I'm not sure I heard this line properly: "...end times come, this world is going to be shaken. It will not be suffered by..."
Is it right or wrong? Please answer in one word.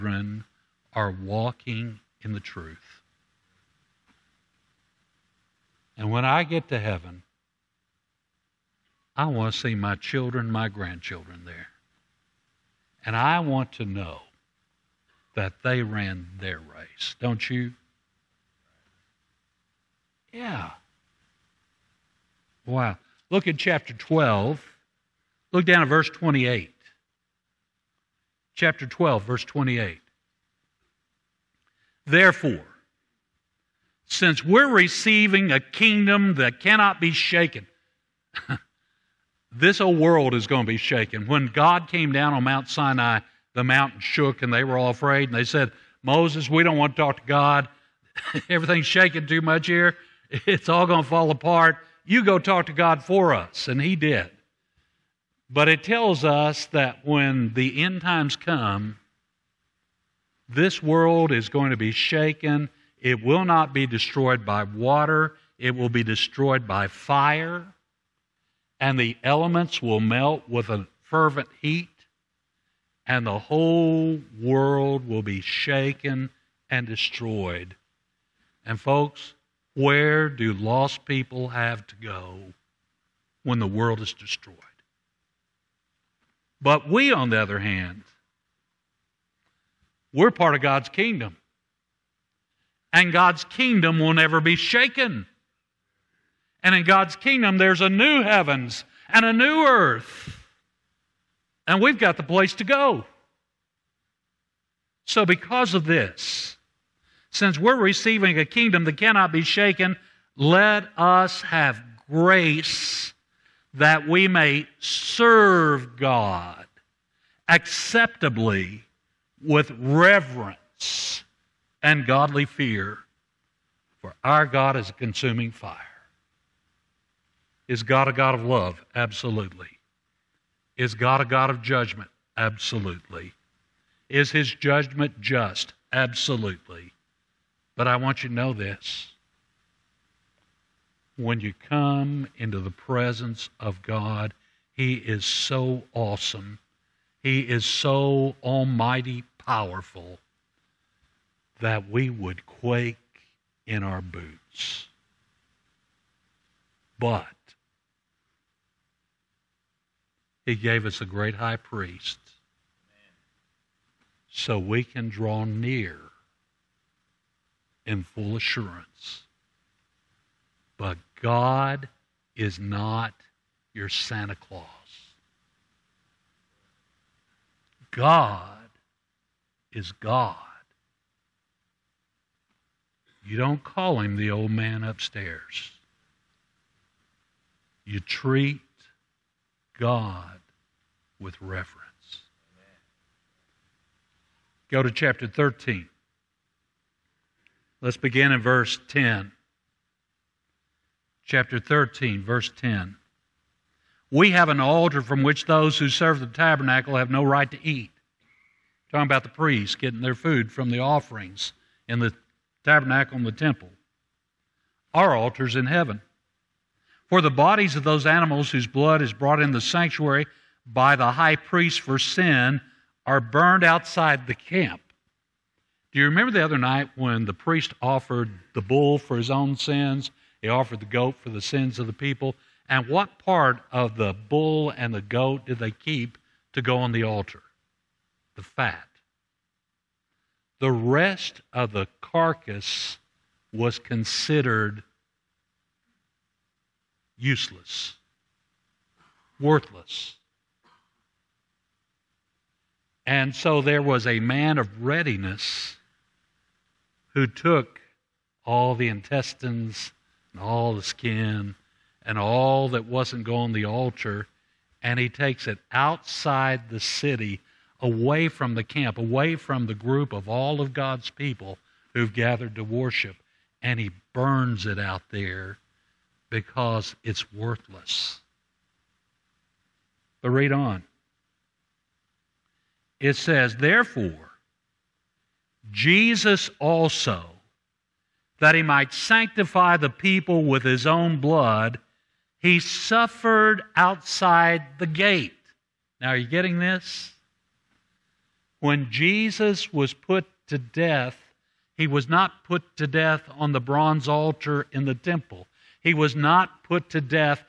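wrong.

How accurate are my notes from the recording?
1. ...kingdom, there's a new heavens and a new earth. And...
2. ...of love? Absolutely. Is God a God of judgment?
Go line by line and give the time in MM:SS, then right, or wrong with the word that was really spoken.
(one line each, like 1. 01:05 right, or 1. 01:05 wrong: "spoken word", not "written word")
1. 01:37 right
2. 02:08 right.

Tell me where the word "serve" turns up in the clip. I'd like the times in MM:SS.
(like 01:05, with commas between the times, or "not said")
01:54, 03:25.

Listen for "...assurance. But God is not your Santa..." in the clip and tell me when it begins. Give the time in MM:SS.
02:48.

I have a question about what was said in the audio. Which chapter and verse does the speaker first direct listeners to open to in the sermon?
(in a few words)
Chapter 12, verse 28.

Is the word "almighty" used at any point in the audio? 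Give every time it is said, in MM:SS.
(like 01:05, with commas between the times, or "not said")
02:28.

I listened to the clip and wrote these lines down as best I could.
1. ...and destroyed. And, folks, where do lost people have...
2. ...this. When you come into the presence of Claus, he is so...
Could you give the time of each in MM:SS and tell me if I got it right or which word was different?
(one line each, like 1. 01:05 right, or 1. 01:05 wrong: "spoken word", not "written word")
1. 01:16 right
2. 02:18 wrong: "God", not "Claus".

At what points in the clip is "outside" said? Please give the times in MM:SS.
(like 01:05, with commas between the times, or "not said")
03:43, 04:25, 04:53.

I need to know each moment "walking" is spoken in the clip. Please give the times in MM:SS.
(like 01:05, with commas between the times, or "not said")
00:01.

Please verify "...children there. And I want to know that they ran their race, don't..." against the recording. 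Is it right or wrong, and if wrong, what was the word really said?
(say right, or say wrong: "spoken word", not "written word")
wrong: "grandchildren", not "children".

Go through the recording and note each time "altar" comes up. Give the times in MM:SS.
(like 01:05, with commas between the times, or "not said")
03:24, 03:35, 03:57, 04:23, 05:04.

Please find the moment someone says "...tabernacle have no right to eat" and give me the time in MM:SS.
03:26.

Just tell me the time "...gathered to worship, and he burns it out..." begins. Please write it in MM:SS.
04:32.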